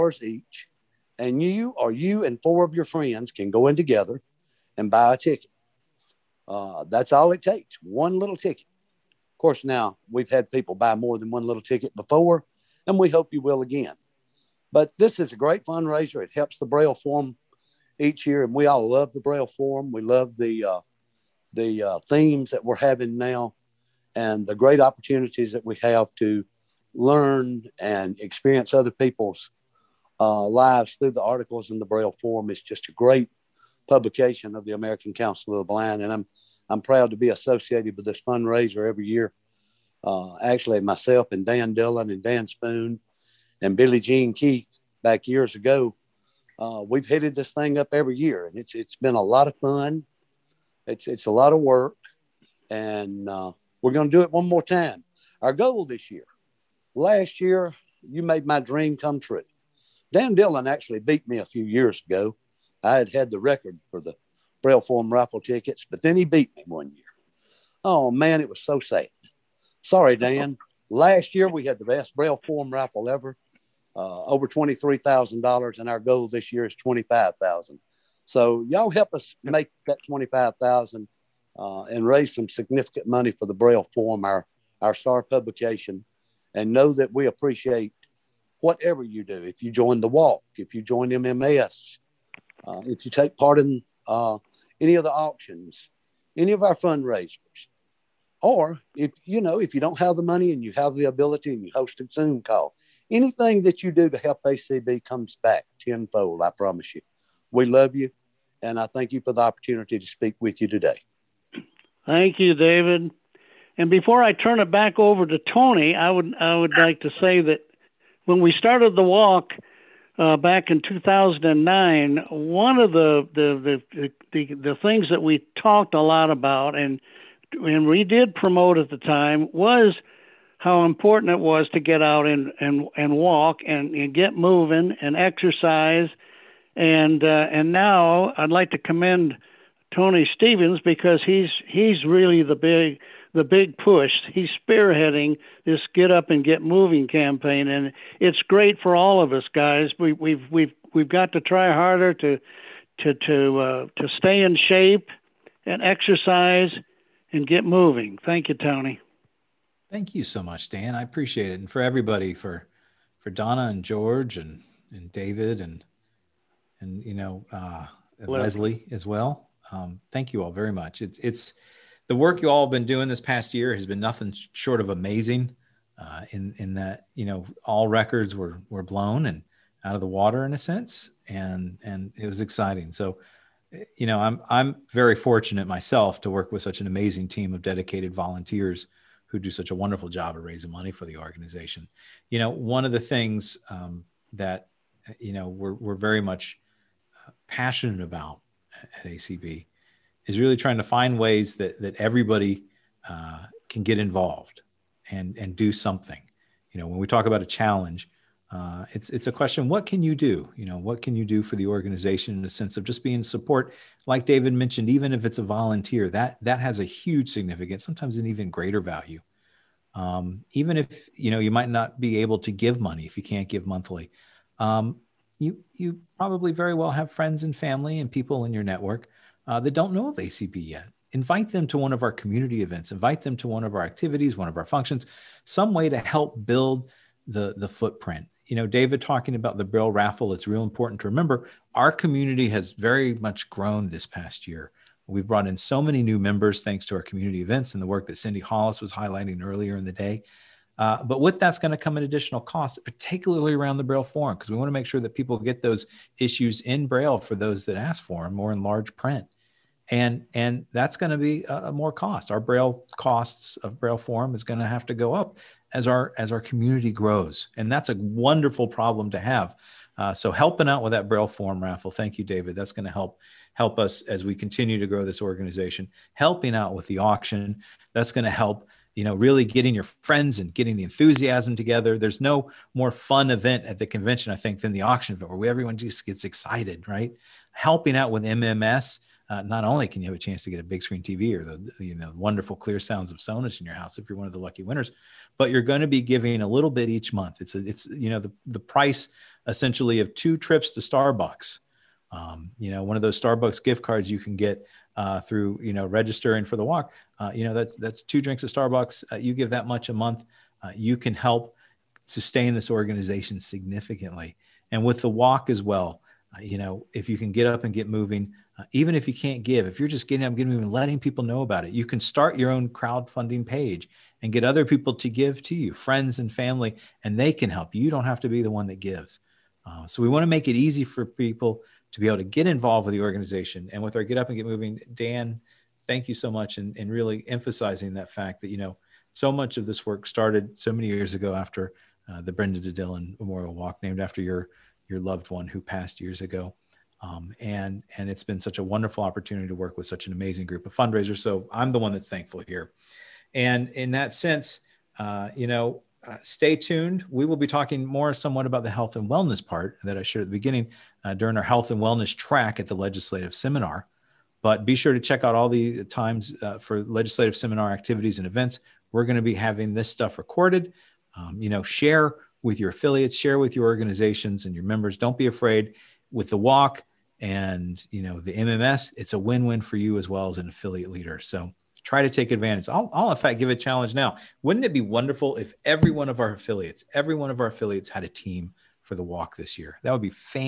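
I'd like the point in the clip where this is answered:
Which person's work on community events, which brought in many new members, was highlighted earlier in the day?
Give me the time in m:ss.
4:08.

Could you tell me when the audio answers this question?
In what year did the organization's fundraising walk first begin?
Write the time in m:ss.
2:00.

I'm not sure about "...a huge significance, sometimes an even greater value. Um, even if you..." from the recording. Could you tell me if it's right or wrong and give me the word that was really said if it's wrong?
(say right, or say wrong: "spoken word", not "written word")
right.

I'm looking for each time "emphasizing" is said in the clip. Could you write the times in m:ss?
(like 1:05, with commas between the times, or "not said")
5:37.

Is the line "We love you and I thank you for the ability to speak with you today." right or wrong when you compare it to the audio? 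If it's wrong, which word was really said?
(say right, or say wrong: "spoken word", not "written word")
wrong: "opportunity", not "ability".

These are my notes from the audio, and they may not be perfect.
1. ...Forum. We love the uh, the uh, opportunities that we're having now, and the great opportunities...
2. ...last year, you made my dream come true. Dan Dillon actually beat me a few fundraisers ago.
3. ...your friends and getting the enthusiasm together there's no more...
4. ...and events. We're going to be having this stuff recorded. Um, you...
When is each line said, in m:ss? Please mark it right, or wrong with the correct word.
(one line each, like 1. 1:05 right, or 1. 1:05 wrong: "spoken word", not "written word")
1. 0:19 wrong: "themes", not "opportunities"
2. 0:56 wrong: "years", not "fundraisers"
3. 4:39 right
4. 6:08 right.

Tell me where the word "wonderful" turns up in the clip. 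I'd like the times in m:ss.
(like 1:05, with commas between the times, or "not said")
3:09, 4:27, 4:52, 5:48, 6:24.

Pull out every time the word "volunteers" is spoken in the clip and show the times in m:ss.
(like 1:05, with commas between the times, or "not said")
3:08, 3:35.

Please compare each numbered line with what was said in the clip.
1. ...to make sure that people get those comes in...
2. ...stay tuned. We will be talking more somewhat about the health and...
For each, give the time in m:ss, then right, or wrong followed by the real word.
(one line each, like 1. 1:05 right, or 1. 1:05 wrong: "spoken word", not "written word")
1. 4:14 wrong: "issues", not "comes"
2. 5:56 right.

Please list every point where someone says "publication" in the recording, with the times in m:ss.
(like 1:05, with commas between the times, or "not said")
0:33, 1:25.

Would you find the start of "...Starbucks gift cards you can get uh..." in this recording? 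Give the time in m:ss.
5:03.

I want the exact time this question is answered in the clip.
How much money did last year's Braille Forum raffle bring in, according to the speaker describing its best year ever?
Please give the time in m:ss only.
1:14.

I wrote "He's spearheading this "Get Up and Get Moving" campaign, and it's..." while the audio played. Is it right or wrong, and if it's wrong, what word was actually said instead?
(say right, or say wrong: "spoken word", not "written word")
right.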